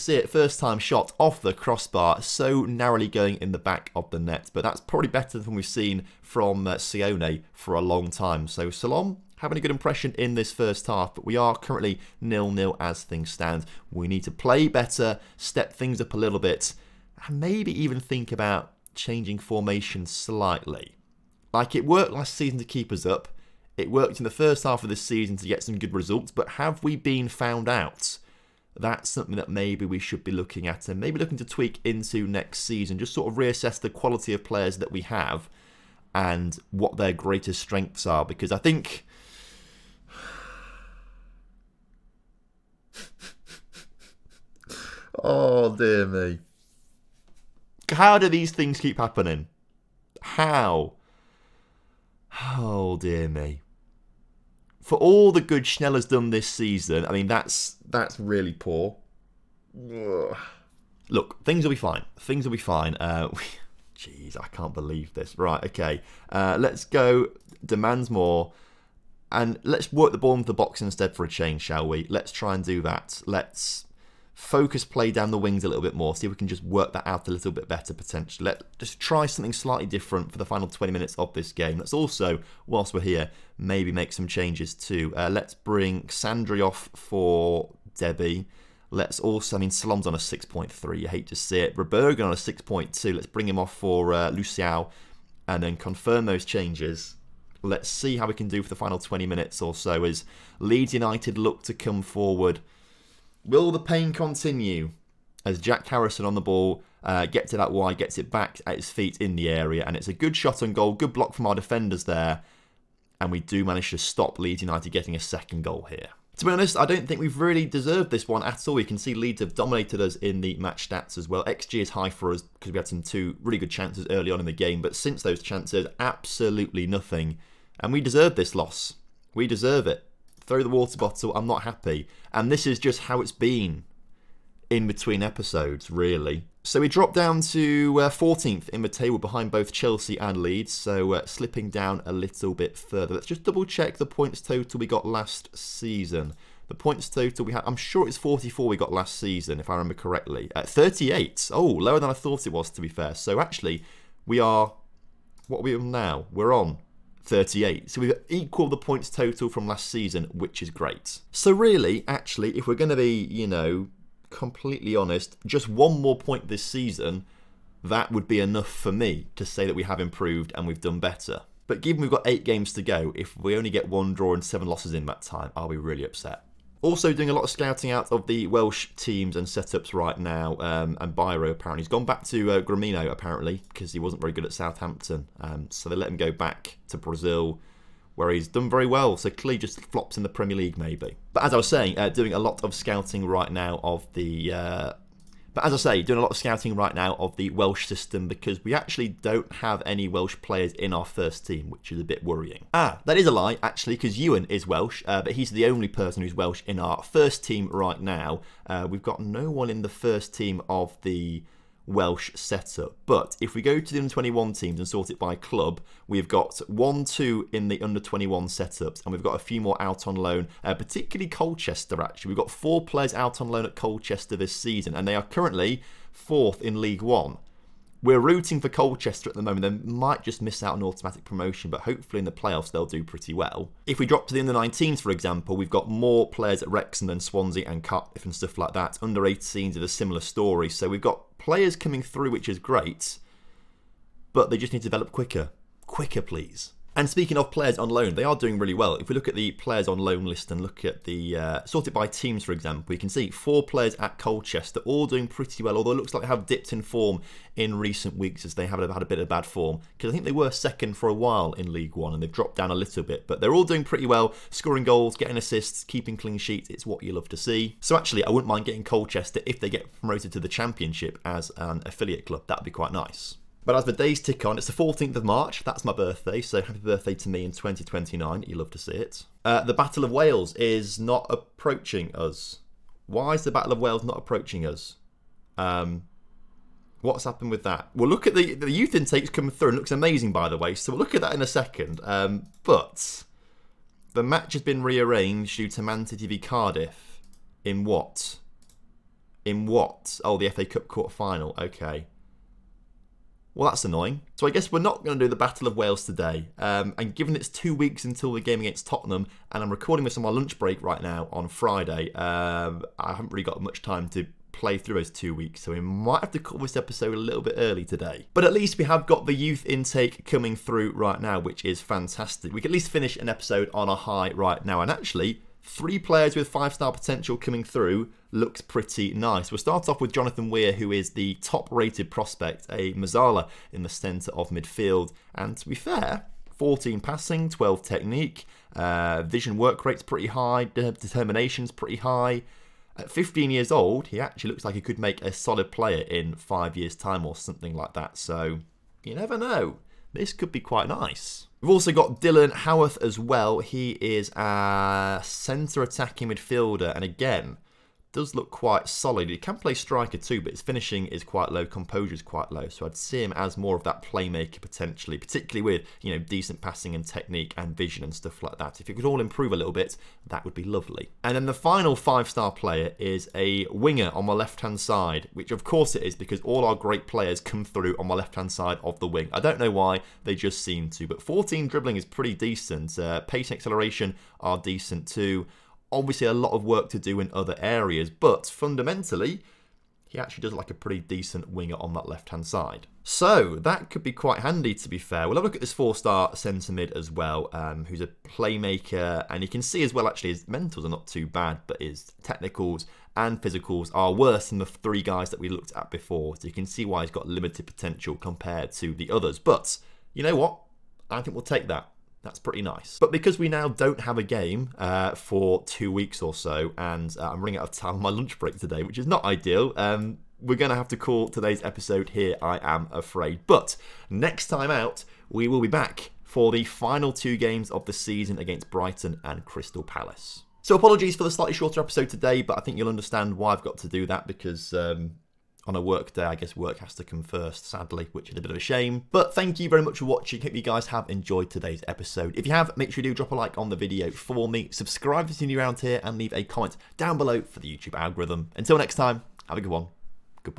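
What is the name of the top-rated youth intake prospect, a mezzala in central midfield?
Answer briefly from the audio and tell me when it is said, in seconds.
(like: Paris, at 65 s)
Jonathan Weir, at 330 s.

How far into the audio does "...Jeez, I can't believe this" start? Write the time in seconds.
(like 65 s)
63 s.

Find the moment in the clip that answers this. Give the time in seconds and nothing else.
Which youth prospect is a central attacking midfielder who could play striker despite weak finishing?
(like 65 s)
352 s.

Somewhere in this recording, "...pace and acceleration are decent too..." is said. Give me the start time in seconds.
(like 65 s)
383 s.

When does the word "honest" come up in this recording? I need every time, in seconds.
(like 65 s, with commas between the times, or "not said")
116 s, 164 s.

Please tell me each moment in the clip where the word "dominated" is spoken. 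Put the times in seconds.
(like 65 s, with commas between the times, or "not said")
119 s.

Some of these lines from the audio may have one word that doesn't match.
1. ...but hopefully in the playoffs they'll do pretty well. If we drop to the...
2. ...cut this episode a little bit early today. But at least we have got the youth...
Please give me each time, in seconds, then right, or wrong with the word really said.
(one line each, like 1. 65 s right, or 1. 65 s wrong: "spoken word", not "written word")
1. 231 s right
2. 316 s right.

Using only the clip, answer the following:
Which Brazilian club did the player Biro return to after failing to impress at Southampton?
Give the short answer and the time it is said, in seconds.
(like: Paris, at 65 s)
Grêmio, at 182 s.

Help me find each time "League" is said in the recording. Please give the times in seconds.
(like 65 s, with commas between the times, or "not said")
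190 s, 226 s, 261 s.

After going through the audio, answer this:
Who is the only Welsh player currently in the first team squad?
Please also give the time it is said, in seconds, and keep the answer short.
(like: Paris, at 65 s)
Ewan, at 204 s.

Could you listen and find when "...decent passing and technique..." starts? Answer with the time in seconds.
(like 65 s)
366 s.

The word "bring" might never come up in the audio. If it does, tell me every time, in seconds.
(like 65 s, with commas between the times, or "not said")
85 s, 93 s.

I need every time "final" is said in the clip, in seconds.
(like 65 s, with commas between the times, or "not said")
80 s, 98 s, 301 s, 371 s, 426 s.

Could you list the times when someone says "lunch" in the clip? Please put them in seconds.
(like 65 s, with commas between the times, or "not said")
310 s, 418 s.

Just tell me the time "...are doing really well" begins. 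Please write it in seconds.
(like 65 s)
248 s.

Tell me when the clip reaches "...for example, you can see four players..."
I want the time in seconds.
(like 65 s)
252 s.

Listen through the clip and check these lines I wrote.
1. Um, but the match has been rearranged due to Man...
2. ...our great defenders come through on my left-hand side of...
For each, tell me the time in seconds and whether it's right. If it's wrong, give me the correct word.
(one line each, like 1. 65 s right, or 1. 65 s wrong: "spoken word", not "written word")
1. 292 s right
2. 376 s wrong: "players", not "defenders".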